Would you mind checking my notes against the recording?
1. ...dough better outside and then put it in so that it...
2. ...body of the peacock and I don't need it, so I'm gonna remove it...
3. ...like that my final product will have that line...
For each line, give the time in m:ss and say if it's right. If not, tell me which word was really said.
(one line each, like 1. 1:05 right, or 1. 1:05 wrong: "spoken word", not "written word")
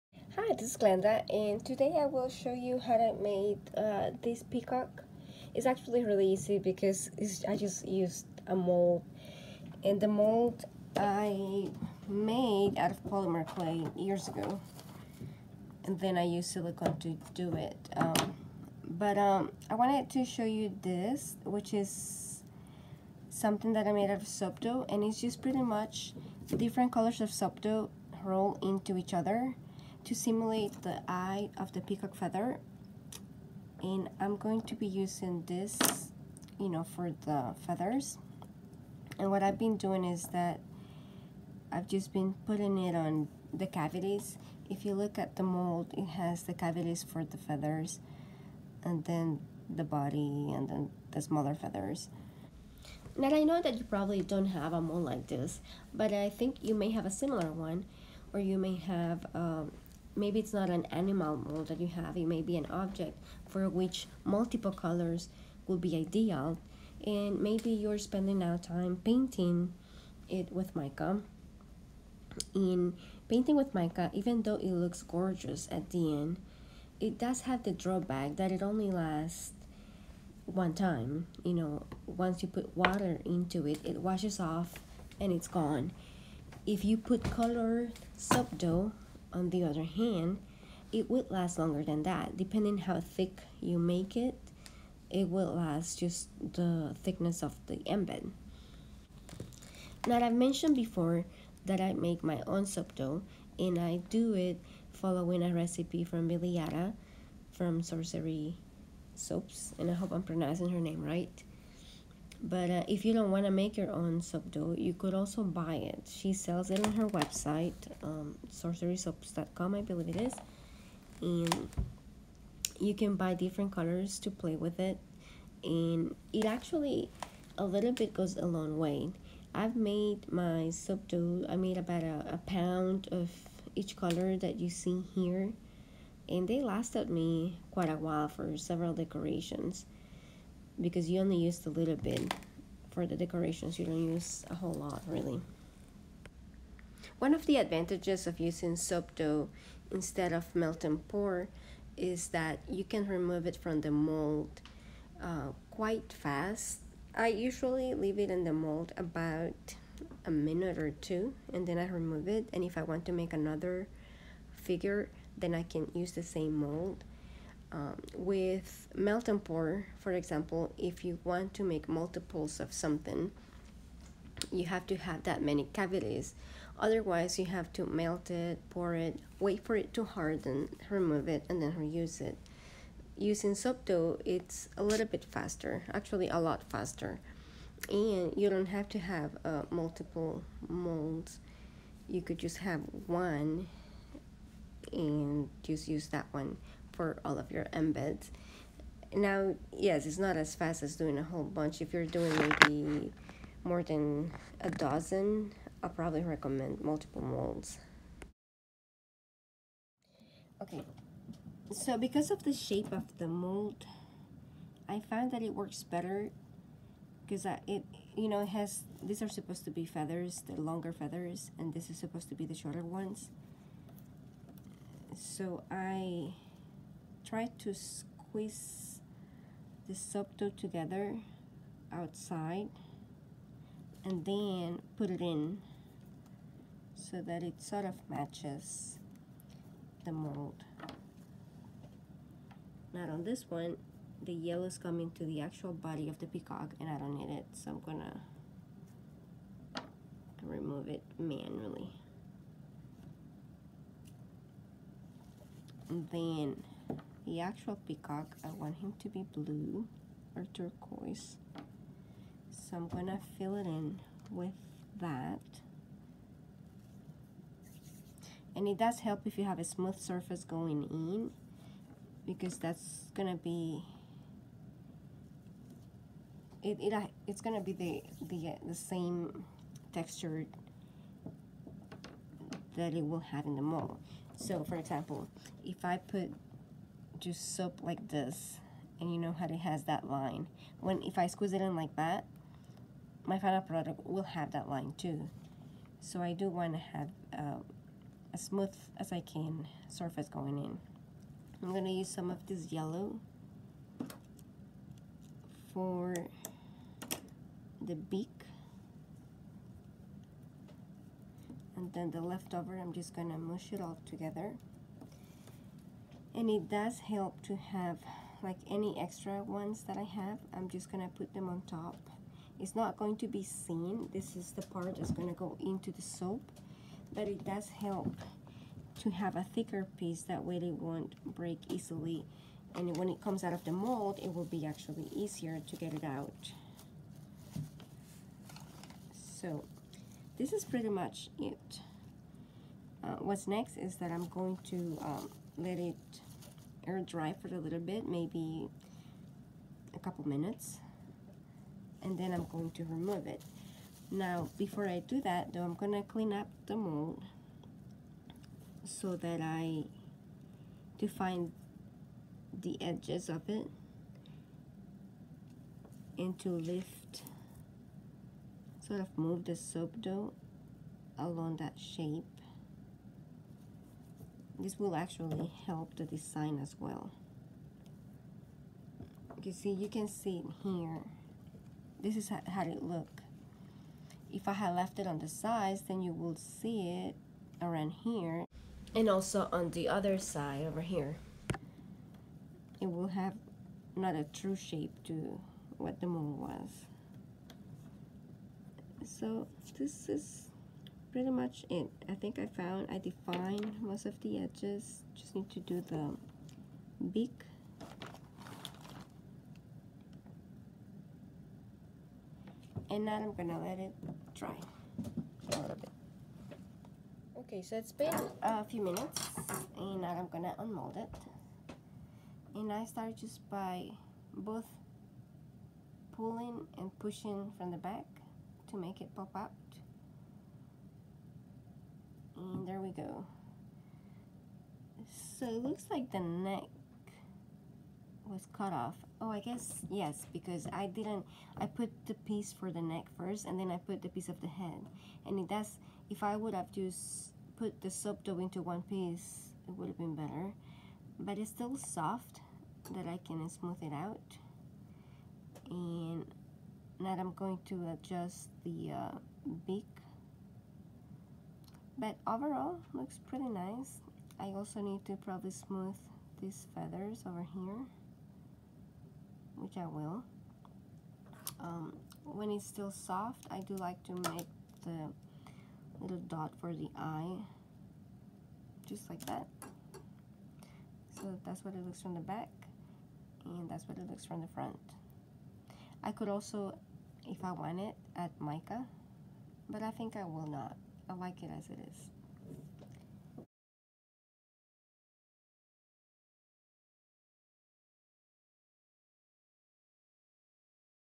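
1. 3:50 wrong: "together", not "better"
2. 4:05 right
3. 4:51 right.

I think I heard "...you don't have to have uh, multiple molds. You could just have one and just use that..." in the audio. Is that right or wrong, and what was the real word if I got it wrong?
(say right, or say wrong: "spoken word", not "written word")
right.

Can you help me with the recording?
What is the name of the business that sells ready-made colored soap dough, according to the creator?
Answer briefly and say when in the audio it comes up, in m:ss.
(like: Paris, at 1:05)
Sorcery Soaps, at 1:47.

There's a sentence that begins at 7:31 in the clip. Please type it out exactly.
But it's still soft that I can smooth it out.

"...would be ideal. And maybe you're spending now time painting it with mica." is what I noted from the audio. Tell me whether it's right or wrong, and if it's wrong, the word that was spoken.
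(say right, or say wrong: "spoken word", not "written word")
right.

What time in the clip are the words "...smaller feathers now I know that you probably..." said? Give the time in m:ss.
0:51.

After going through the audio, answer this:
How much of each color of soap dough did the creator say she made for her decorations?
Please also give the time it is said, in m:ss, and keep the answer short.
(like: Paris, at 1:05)
a pound, at 2:12.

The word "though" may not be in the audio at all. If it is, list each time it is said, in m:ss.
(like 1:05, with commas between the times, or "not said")
1:14, 5:55.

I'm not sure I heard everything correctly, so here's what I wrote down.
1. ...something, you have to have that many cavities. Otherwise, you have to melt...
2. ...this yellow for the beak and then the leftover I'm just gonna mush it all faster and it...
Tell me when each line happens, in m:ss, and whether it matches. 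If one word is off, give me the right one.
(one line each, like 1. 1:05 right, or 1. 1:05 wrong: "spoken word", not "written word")
1. 2:52 right
2. 5:02 wrong: "together", not "faster".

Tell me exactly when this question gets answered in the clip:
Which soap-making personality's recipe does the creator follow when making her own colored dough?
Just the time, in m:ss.
1:46.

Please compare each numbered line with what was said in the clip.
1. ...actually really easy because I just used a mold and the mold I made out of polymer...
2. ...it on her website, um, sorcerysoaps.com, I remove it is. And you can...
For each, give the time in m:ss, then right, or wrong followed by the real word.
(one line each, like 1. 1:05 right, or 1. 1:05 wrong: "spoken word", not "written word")
1. 0:05 right
2. 1:56 wrong: "believe", not "remove".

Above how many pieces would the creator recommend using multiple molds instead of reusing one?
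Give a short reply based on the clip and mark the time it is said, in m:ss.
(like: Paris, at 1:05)
a dozen, at 3:24.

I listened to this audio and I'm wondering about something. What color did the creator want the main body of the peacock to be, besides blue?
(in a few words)
turquoise.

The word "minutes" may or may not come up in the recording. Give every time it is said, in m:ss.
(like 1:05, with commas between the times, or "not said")
2:40, 5:50, 6:58.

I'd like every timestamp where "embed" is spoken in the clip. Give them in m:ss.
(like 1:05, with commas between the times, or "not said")
1:37, 3:17.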